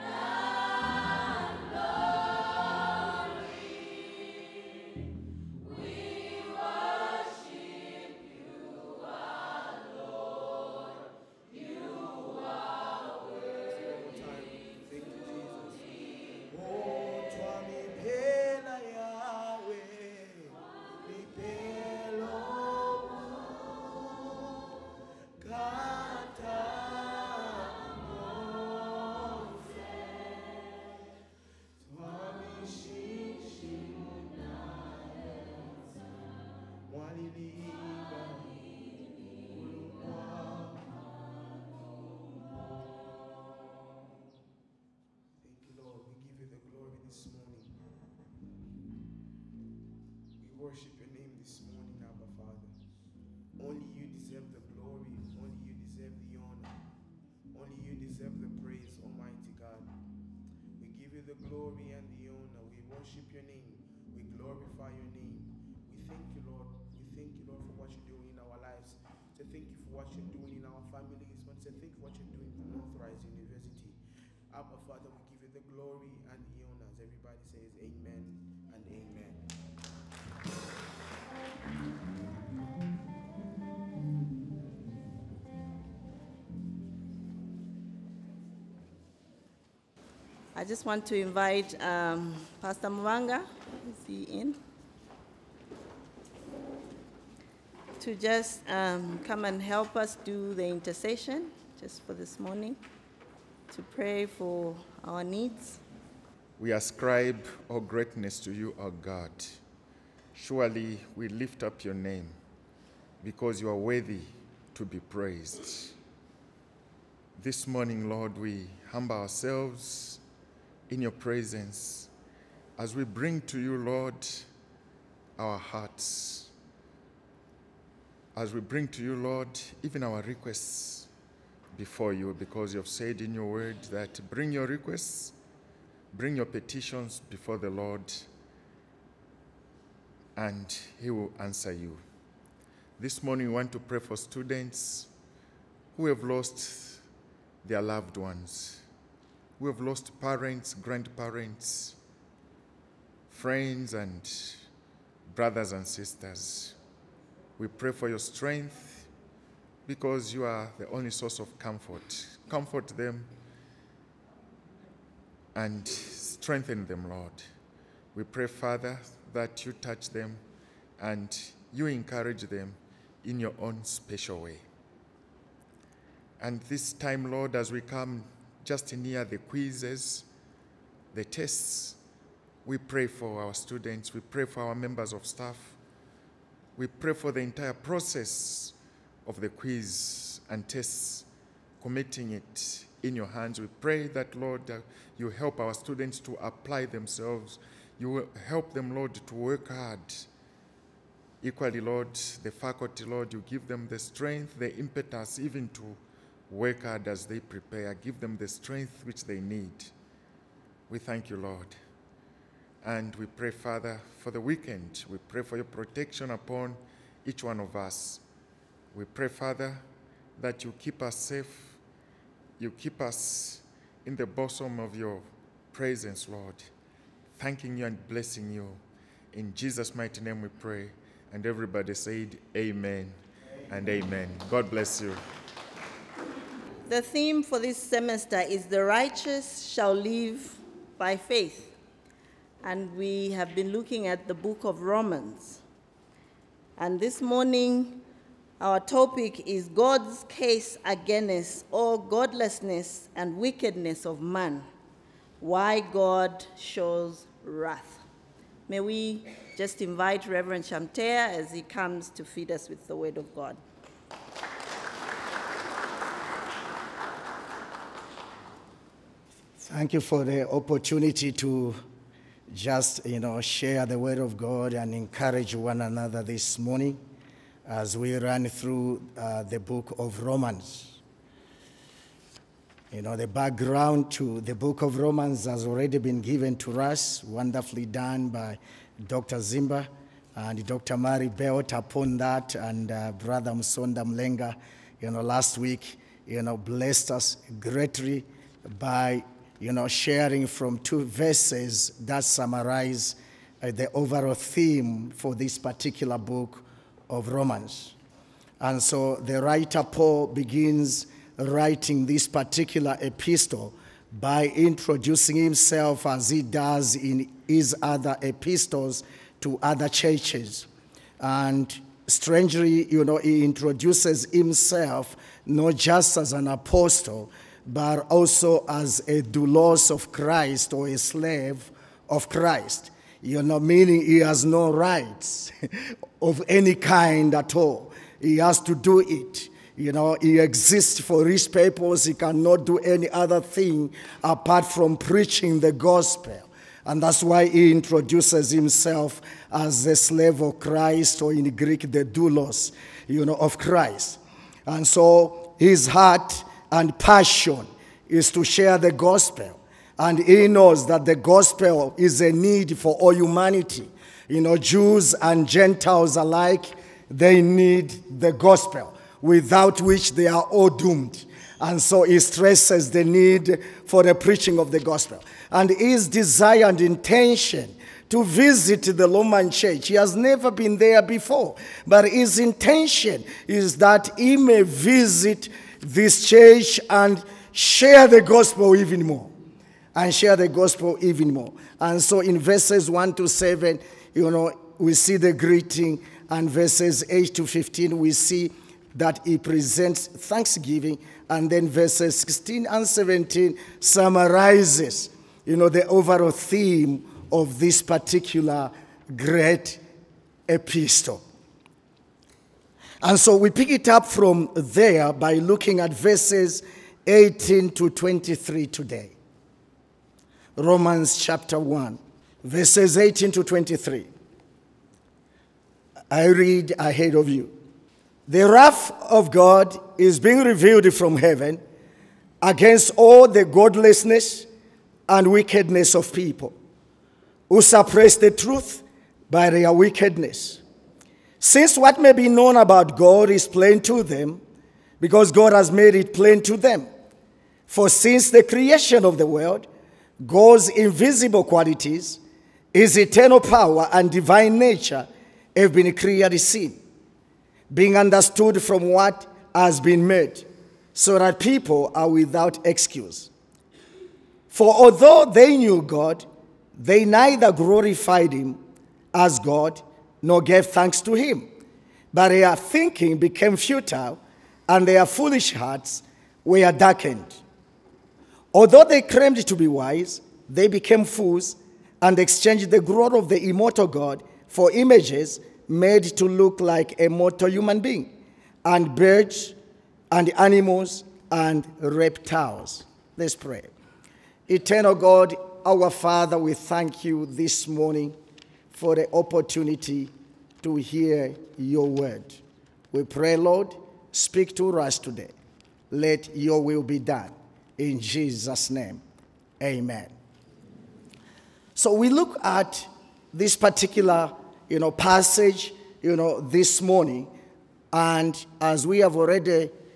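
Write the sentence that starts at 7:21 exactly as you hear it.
Since what may be known about God is plain to them, because God has made it plain to them.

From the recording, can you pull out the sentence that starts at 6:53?
And so we pick it up from there by looking at verses 18 to 23 today.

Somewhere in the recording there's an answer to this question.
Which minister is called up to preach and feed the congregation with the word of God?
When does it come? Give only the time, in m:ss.
4:20.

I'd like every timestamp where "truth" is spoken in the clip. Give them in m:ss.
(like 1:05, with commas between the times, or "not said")
7:18.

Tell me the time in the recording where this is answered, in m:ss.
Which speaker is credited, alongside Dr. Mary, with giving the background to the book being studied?
4:49.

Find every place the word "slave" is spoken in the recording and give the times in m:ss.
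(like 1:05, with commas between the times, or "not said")
5:30, 5:49.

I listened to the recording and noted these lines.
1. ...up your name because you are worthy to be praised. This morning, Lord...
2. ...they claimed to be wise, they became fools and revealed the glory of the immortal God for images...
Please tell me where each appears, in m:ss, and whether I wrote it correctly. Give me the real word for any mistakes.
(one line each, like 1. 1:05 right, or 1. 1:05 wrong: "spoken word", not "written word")
1. 1:51 right
2. 7:58 wrong: "exchanged", not "revealed".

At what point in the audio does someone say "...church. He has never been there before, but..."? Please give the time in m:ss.
6:19.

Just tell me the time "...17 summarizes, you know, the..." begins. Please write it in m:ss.
6:42.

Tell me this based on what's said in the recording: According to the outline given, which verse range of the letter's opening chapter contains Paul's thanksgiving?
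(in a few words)
8 to 15.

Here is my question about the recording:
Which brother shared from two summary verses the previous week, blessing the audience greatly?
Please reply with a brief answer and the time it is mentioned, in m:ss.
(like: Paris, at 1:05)
Msonda Mlenga, at 4:53.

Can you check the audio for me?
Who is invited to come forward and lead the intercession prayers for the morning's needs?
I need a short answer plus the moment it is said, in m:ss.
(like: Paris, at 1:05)
Pastor Mwanga, at 1:32.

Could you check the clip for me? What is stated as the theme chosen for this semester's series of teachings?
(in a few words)
The Righteous Shall Live by Faith.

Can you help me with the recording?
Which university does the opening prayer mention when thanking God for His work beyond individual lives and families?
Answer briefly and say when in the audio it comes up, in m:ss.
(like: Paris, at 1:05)
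Northrise University, at 1:12.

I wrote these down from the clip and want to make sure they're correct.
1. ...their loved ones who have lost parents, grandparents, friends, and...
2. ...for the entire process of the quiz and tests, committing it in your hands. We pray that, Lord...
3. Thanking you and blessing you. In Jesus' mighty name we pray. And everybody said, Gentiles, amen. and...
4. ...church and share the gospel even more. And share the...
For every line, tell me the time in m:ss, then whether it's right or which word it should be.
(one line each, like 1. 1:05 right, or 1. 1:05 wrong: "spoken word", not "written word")
1. 2:27 right
2. 3:07 right
3. 3:47 wrong: "Amen", not "Gentiles"
4. 6:26 right.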